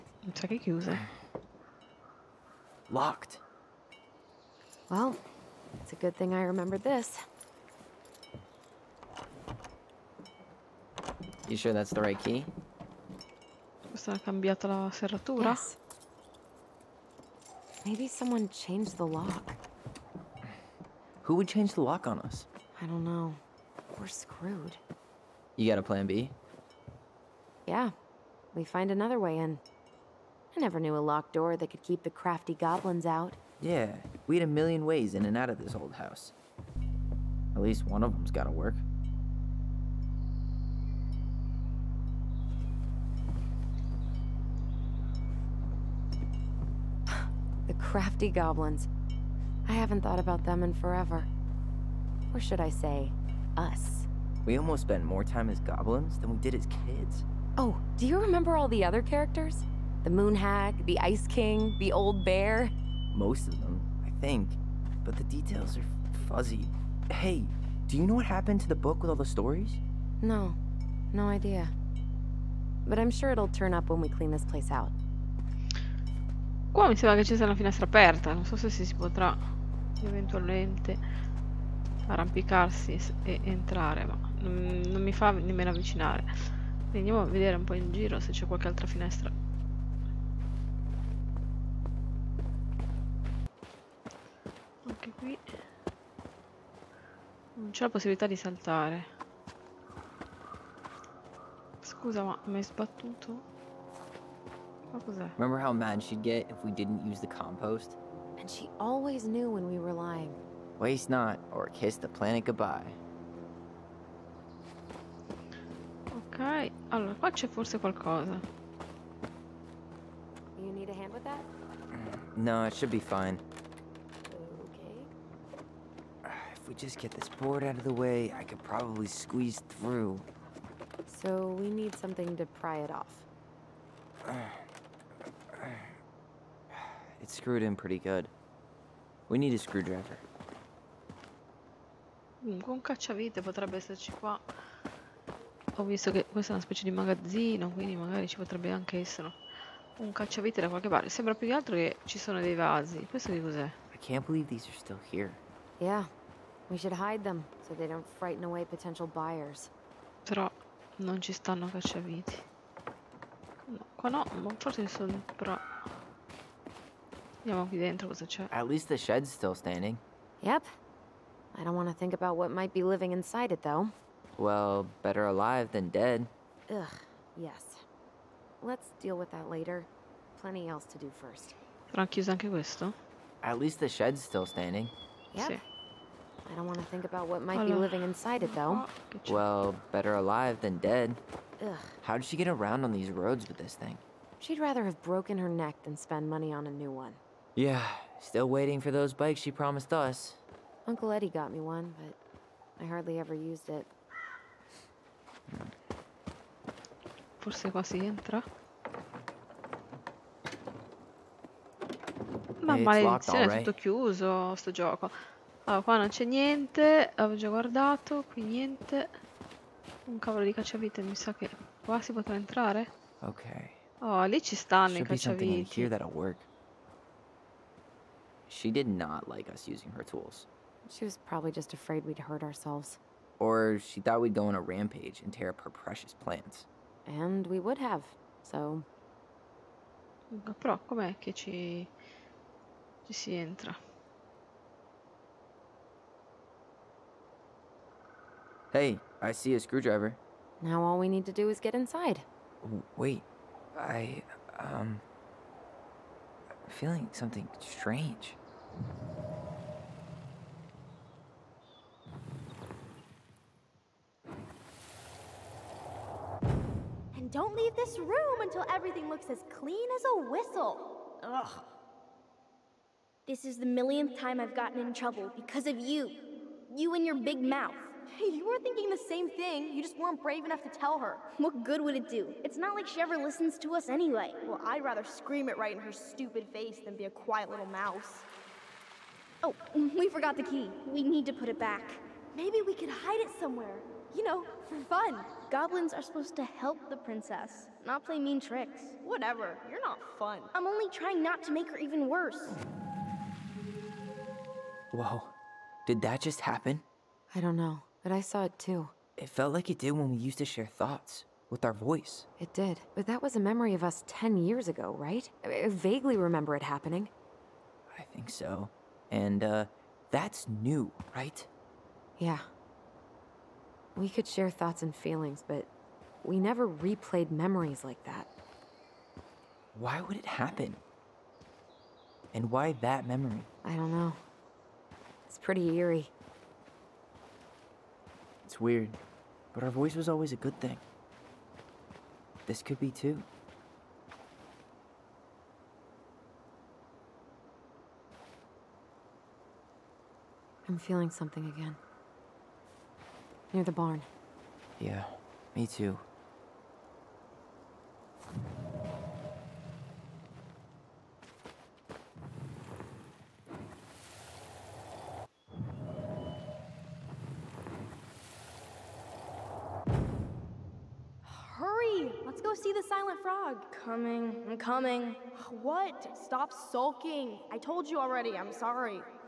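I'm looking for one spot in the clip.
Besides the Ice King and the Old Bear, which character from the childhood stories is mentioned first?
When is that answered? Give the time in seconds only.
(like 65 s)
60 s.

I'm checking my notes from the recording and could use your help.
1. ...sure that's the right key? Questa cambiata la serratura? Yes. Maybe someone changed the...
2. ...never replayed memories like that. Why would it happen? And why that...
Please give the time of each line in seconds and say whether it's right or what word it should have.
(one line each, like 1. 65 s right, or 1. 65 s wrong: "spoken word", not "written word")
1. 11 s right
2. 326 s right.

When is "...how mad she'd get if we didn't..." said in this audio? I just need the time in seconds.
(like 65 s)
105 s.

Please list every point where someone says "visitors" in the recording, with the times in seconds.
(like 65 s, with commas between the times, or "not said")
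not said.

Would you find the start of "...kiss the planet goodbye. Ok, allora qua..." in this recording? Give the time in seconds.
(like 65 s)
111 s.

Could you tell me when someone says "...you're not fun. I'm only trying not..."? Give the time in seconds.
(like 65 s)
299 s.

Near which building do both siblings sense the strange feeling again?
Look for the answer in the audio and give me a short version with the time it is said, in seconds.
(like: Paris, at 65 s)
the barn, at 353 s.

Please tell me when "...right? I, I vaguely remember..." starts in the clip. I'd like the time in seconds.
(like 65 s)
314 s.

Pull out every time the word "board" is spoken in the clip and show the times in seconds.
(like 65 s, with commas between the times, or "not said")
127 s.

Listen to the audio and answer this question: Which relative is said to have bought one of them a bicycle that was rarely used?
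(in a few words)
Uncle Eddie.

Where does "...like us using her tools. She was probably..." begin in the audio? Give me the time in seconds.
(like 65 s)
229 s.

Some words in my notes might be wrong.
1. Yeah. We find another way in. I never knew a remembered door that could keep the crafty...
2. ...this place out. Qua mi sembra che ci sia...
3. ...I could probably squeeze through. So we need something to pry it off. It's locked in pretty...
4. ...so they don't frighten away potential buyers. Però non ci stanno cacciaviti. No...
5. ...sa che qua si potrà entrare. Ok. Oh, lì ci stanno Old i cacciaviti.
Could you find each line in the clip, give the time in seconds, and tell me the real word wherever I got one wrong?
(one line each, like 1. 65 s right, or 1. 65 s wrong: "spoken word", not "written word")
1. 27 s wrong: "locked", not "remembered"
2. 74 s right
3. 128 s wrong: "screwed", not "locked"
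4. 157 s right
5. 221 s wrong: "Should", not "Old".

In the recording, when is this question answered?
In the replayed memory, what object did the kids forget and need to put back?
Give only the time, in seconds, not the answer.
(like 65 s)
290 s.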